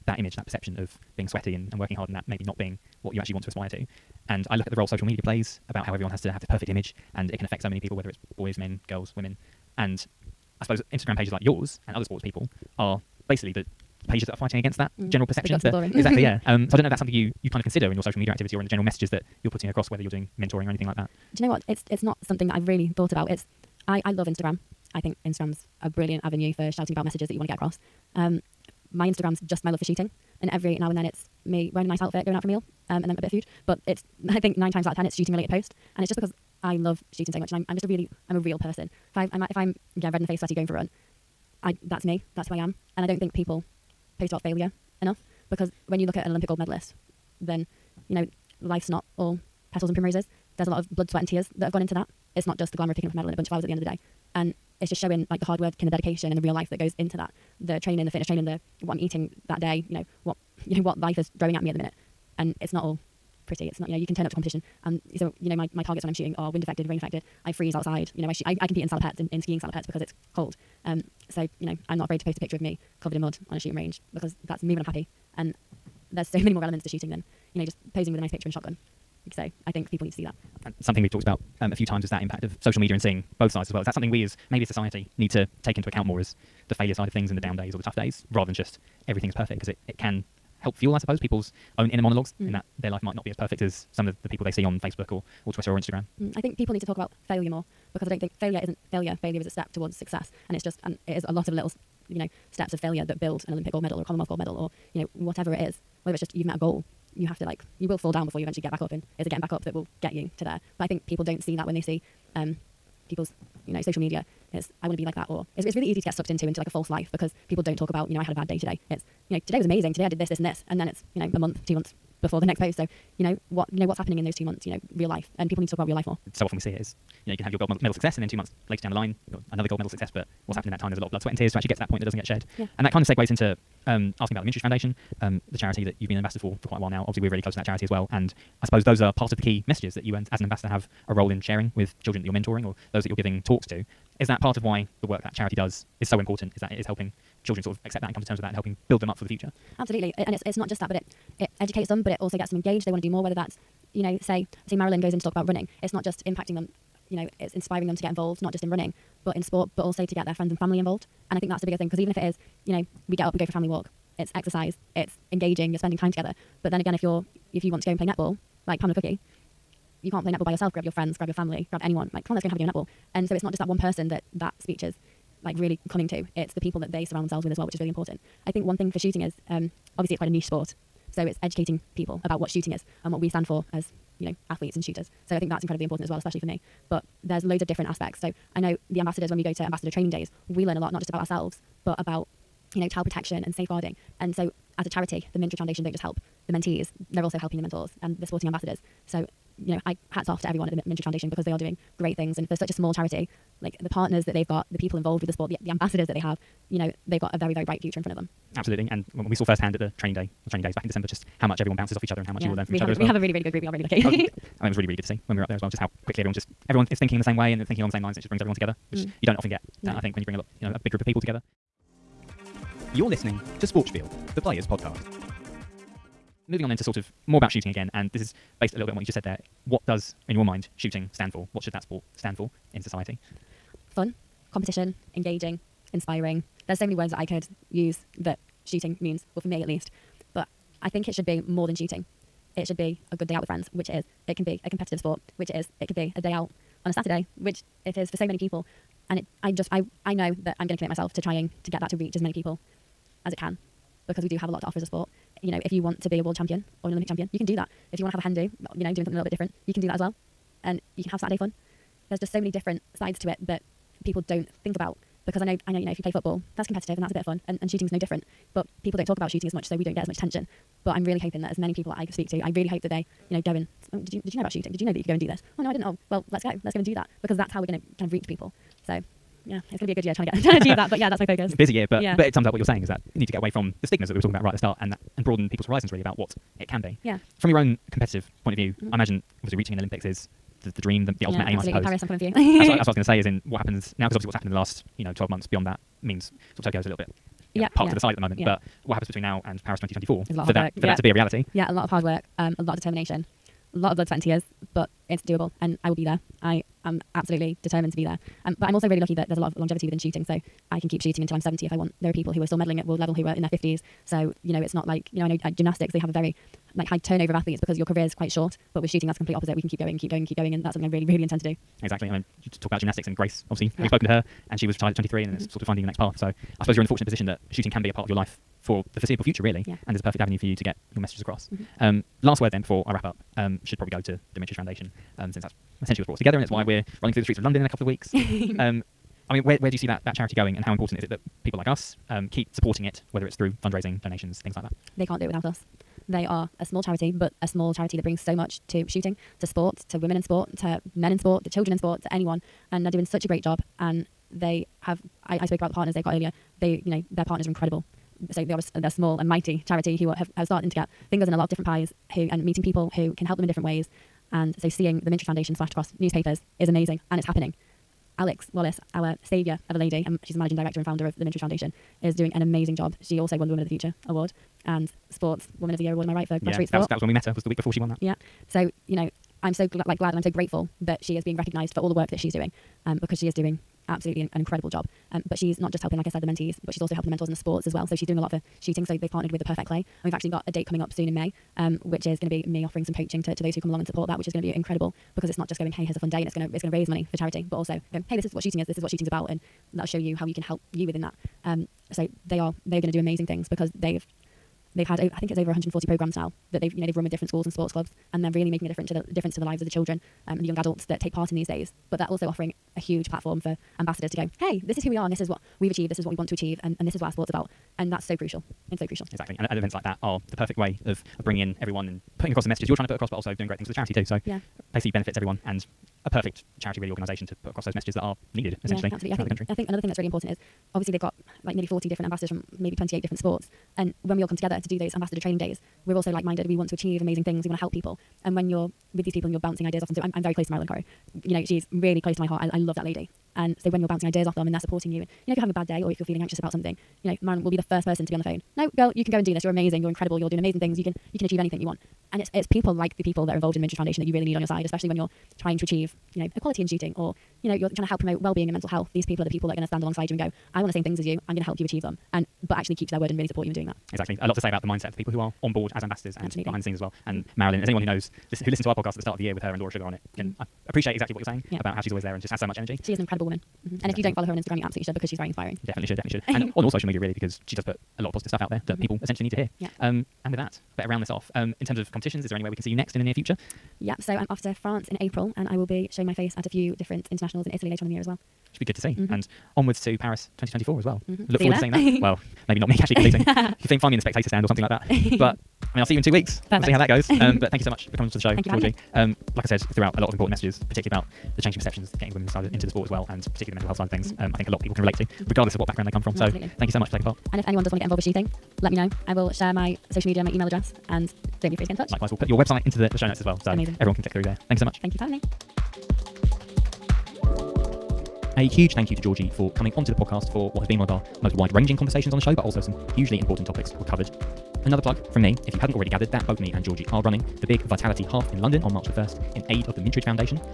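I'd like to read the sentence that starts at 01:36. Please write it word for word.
Mm, I think people need to talk about failure more because I don't think failure isn't failure.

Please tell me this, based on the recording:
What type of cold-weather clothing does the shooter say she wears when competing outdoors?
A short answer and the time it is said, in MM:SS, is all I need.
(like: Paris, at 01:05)
Skiing salopettes, at 01:09.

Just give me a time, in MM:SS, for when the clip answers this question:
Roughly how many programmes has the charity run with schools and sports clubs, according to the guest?
06:45.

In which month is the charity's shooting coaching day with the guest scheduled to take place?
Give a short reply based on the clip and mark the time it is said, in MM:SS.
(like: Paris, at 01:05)
May, at 06:31.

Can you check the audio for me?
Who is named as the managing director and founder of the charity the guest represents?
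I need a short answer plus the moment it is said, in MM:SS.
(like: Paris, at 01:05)
Alex Wallace, at 06:08.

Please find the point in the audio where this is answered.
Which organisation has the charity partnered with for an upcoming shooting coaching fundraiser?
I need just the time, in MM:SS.
06:29.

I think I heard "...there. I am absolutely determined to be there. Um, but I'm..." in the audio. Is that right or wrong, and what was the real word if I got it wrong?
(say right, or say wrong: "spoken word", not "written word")
right.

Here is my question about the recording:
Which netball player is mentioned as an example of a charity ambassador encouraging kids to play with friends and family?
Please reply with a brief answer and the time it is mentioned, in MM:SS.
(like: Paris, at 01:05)
Pamela Cookey, at 02:48.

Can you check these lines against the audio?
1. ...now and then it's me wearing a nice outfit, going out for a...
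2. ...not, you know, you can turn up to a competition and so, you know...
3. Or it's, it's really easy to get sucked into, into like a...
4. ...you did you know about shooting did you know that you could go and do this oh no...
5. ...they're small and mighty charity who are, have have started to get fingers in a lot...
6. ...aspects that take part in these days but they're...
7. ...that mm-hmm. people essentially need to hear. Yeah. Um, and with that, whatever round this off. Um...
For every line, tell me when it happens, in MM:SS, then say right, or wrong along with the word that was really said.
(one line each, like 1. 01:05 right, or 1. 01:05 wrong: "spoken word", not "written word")
1. 00:30 right
2. 01:03 right
3. 01:55 right
4. 04:34 right
5. 05:58 right
6. 06:50 wrong: "adults", not "aspects"
7. 07:58 wrong: "better", not "whatever".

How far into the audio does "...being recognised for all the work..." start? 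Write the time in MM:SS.
06:21.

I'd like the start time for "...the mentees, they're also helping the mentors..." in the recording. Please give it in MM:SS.
03:16.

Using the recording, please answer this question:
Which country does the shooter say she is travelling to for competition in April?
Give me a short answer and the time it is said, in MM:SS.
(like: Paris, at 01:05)
France, at 08:04.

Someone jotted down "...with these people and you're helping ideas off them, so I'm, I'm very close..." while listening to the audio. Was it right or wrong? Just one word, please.
wrong.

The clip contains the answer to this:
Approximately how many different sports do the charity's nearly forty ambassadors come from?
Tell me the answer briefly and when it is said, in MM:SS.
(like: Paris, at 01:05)
28, at 07:12.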